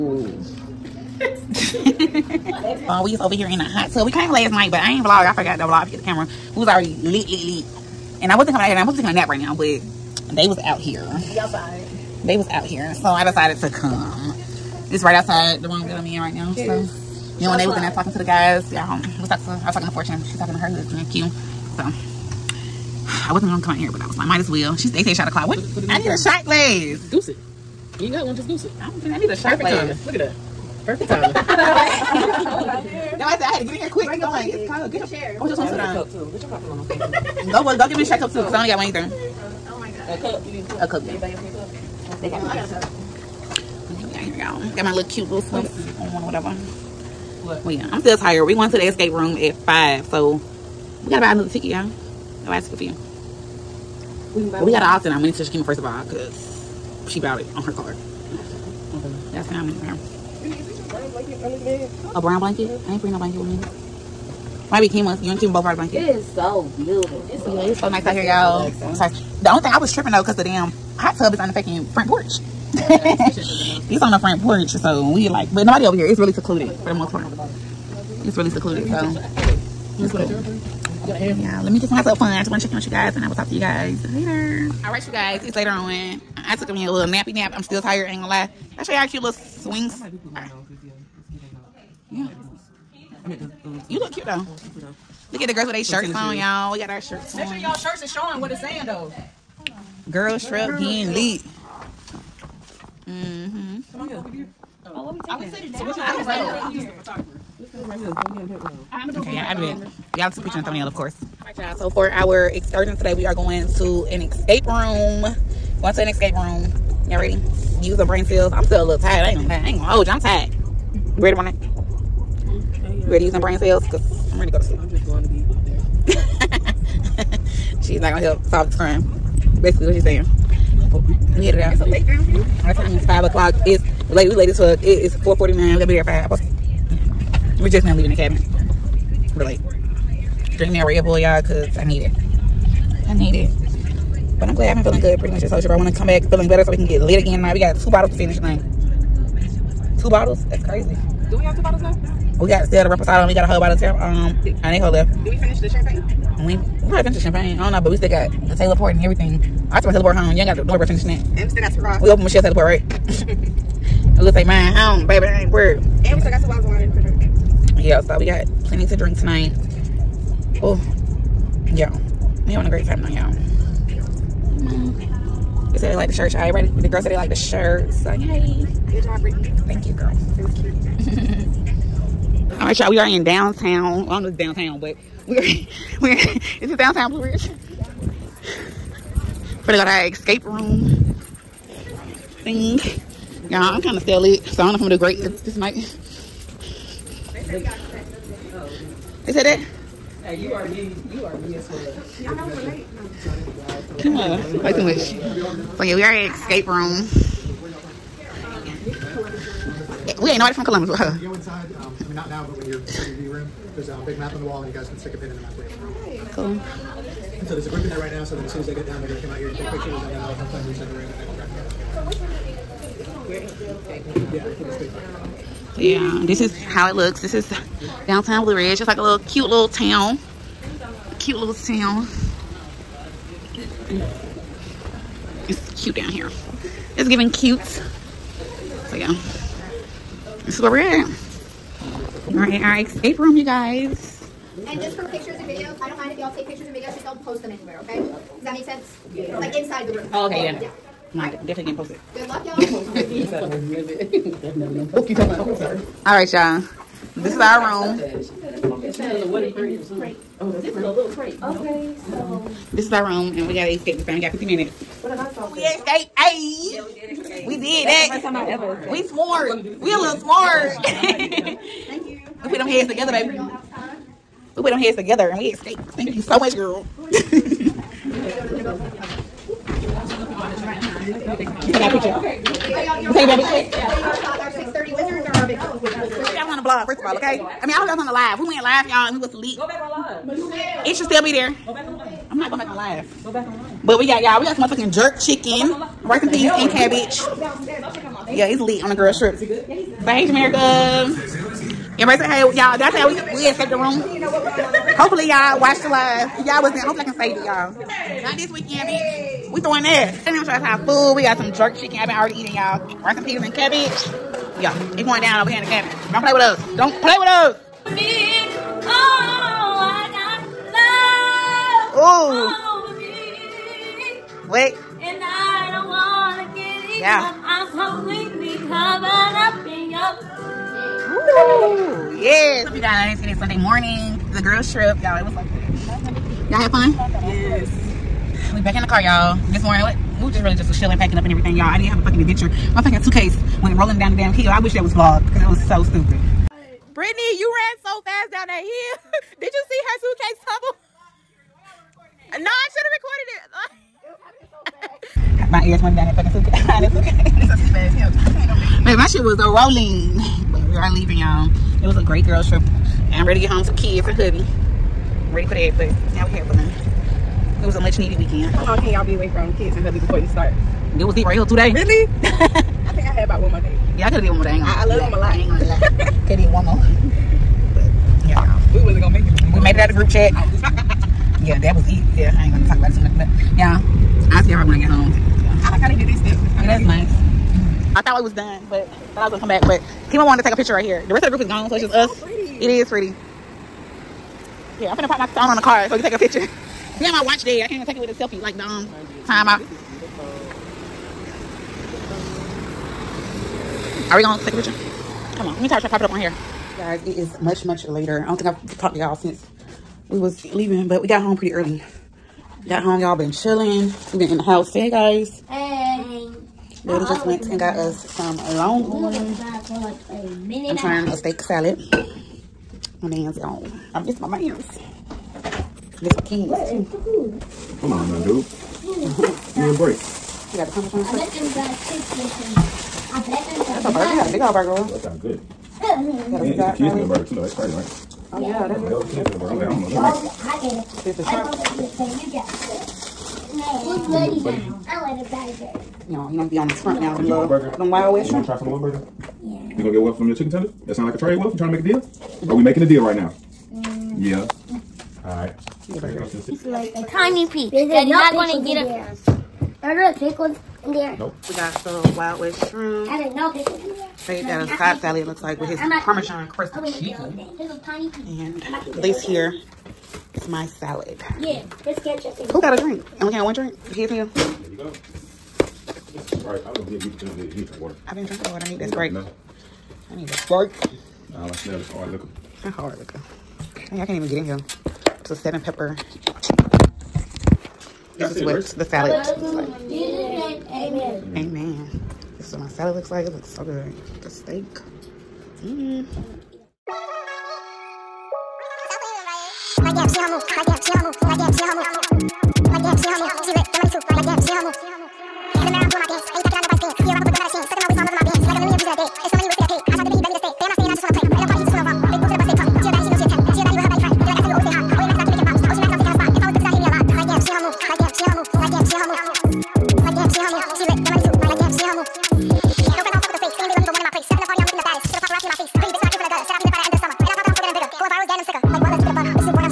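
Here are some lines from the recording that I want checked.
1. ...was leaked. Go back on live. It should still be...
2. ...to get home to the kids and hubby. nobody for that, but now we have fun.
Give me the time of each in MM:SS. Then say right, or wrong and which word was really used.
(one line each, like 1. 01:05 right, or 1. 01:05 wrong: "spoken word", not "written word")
1. 04:49 right
2. 06:03 wrong: "ready", not "nobody".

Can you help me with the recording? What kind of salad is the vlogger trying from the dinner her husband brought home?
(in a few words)
steak salad.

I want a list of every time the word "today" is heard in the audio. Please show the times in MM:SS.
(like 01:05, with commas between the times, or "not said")
01:52, 06:11.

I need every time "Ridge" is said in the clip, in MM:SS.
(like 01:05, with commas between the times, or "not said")
03:07, 03:48.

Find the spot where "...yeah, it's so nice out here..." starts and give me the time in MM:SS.
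01:07.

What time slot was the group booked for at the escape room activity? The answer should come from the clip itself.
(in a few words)
5.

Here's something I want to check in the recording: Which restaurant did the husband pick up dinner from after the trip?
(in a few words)
Longhorn.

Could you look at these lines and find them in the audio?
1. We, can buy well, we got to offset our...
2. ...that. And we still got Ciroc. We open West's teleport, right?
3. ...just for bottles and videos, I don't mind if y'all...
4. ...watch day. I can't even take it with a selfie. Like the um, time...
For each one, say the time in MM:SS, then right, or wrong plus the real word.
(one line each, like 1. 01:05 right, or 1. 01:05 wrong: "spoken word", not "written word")
1. 00:54 right
2. 02:41 wrong: "Michelle", not "West"
3. 04:04 wrong: "pictures", not "bottles"
4. 06:37 right.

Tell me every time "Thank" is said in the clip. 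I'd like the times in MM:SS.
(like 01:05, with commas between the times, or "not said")
02:59, 04:30, 04:35.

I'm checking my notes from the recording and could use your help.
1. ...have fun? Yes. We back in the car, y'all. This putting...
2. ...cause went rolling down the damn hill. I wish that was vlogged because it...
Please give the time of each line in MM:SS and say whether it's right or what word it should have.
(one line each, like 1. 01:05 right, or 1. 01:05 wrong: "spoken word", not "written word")
1. 05:36 wrong: "morning", not "putting"
2. 05:43 wrong: "suitcase", not "cause".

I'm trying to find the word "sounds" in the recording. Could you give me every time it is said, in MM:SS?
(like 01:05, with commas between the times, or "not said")
07:14, 07:30.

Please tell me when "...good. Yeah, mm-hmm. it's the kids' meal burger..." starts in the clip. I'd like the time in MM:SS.
07:15.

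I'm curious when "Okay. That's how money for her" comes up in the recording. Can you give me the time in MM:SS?
00:58.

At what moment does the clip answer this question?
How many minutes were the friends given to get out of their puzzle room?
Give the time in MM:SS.
04:24.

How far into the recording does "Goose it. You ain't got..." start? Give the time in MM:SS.
00:27.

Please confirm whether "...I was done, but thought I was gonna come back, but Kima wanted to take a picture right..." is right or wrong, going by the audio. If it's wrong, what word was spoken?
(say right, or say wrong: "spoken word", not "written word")
right.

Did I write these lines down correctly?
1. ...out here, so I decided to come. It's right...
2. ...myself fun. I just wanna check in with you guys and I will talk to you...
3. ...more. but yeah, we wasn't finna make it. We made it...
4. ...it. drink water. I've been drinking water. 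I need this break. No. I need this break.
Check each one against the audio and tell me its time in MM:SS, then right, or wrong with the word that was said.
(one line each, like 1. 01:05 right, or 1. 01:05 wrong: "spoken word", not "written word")
1. 00:12 right
2. 01:21 right
3. 06:16 wrong: "gonna", not "finna"
4. 07:57 right.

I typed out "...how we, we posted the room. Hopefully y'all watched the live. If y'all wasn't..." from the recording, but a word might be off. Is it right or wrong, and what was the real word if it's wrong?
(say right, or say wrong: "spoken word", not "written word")
wrong: "escaped", not "posted".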